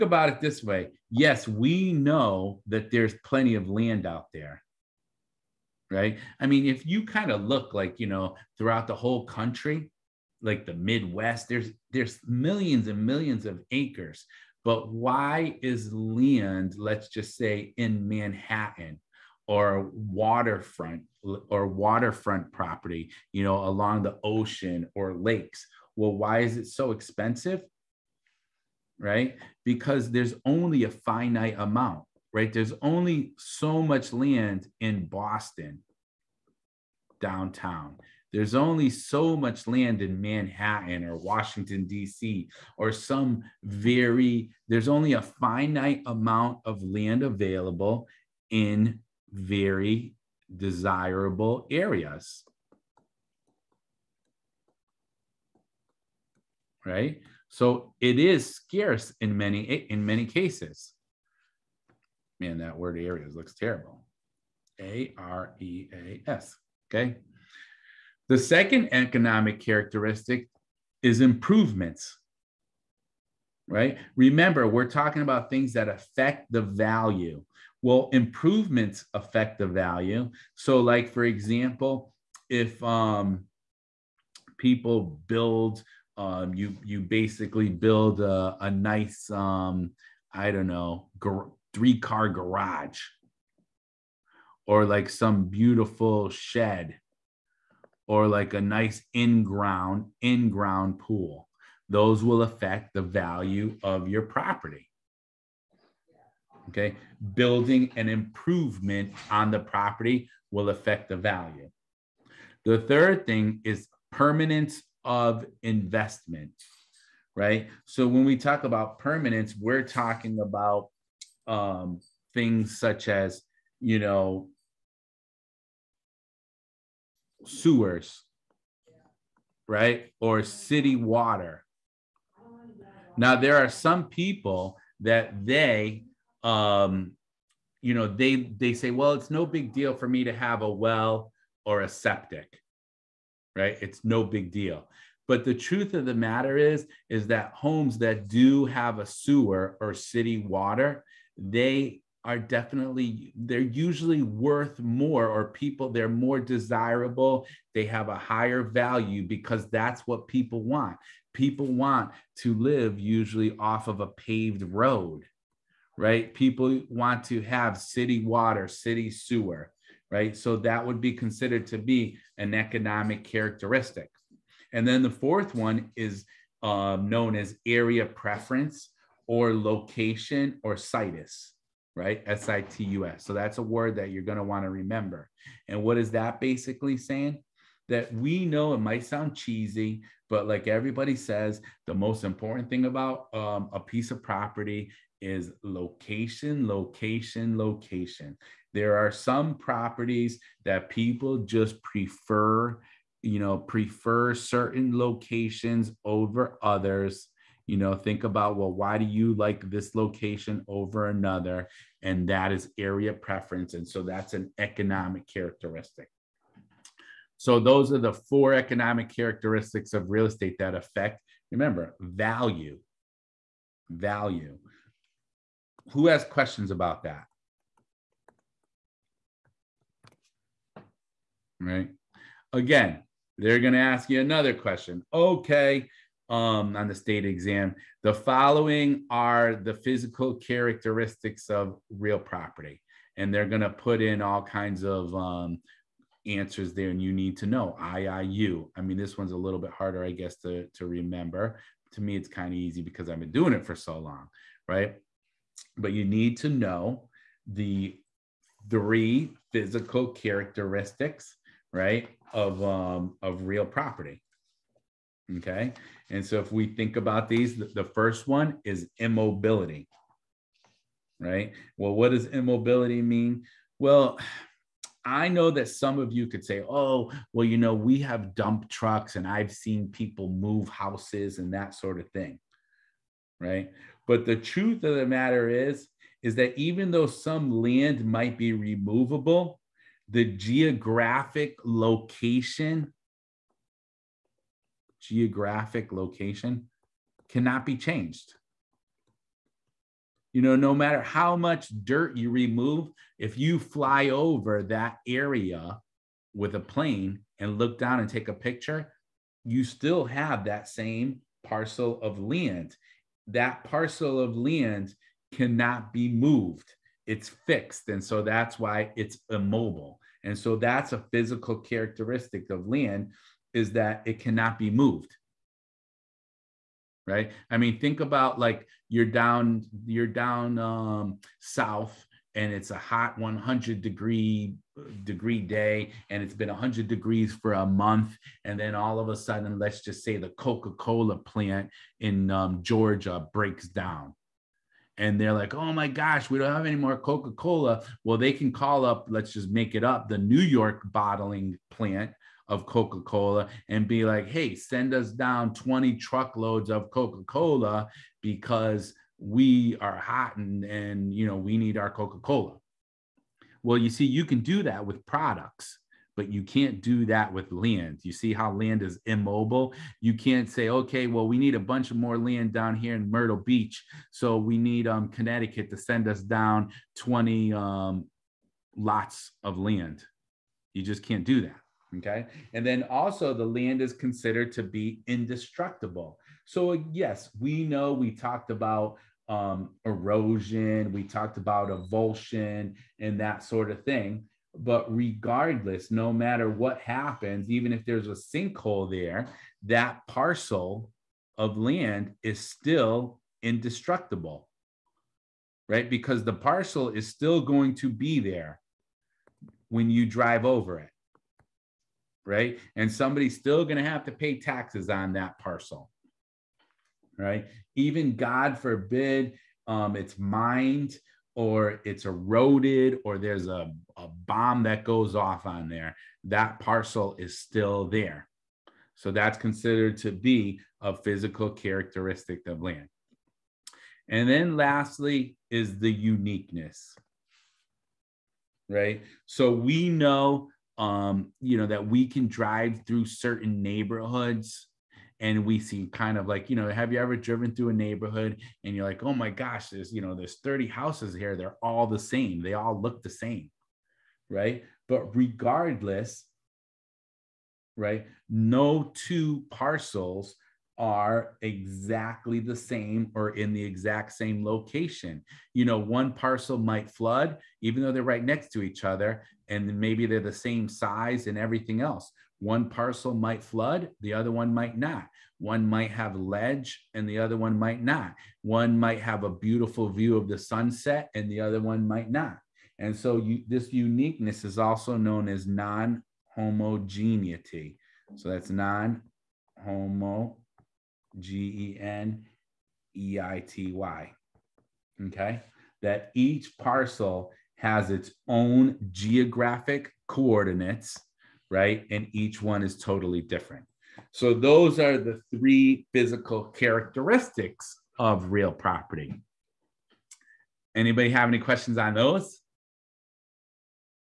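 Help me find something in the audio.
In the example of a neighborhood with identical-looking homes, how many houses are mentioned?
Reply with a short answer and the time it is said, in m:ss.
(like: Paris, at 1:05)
30, at 7:30.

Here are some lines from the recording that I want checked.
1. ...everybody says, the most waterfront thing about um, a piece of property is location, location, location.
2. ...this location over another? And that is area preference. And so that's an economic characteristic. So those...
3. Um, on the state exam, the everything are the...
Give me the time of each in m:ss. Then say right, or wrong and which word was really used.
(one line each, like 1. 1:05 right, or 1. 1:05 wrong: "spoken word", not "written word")
1. 3:10 wrong: "important", not "waterfront"
2. 3:29 right
3. 3:56 wrong: "following", not "everything".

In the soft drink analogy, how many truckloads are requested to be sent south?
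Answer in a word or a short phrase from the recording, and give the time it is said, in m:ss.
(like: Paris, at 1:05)
20, at 5:55.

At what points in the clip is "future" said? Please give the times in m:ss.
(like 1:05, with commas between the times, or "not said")
not said.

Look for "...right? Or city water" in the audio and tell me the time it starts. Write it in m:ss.
2:09.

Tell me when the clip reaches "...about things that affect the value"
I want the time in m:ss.
1:15.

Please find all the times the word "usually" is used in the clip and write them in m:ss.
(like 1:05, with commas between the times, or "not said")
2:33, 2:42.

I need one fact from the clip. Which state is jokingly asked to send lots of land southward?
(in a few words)
Connecticut.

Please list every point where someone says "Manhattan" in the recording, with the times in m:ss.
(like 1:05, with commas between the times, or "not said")
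0:18, 0:40.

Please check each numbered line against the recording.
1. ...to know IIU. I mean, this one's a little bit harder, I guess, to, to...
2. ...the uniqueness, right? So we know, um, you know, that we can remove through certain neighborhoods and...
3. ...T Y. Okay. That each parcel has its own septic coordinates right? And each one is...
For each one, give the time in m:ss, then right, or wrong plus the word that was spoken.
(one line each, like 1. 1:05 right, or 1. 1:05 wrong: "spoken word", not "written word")
1. 4:07 right
2. 7:15 wrong: "drive", not "remove"
3. 8:13 wrong: "geographic", not "septic".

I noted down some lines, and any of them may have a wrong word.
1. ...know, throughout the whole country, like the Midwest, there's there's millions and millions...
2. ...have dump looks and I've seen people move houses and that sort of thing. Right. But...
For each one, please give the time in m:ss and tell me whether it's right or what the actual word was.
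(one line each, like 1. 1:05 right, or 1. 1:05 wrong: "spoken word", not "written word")
1. 0:08 right
2. 4:37 wrong: "trucks", not "looks".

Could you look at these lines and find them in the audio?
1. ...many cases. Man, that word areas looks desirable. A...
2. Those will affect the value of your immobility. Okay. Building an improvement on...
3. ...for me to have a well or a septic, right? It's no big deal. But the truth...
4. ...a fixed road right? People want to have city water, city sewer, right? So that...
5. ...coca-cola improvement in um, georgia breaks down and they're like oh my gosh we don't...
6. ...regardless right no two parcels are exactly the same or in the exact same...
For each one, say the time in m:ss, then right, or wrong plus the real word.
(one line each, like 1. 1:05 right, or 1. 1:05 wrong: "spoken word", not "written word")
1. 1:00 wrong: "terrible", not "desirable"
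2. 1:41 wrong: "property", not "immobility"
3. 2:19 right
4. 2:44 wrong: "paved", not "fixed"
5. 5:40 wrong: "plant", not "improvement"
6. 7:35 right.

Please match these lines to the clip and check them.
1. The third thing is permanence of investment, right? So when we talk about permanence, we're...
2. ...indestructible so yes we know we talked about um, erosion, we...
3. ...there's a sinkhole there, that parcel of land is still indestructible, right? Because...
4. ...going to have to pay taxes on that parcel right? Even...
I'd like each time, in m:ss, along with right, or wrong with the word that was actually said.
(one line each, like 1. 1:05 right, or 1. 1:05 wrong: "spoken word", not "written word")
1. 1:52 right
2. 6:25 right
3. 6:37 right
4. 6:53 right.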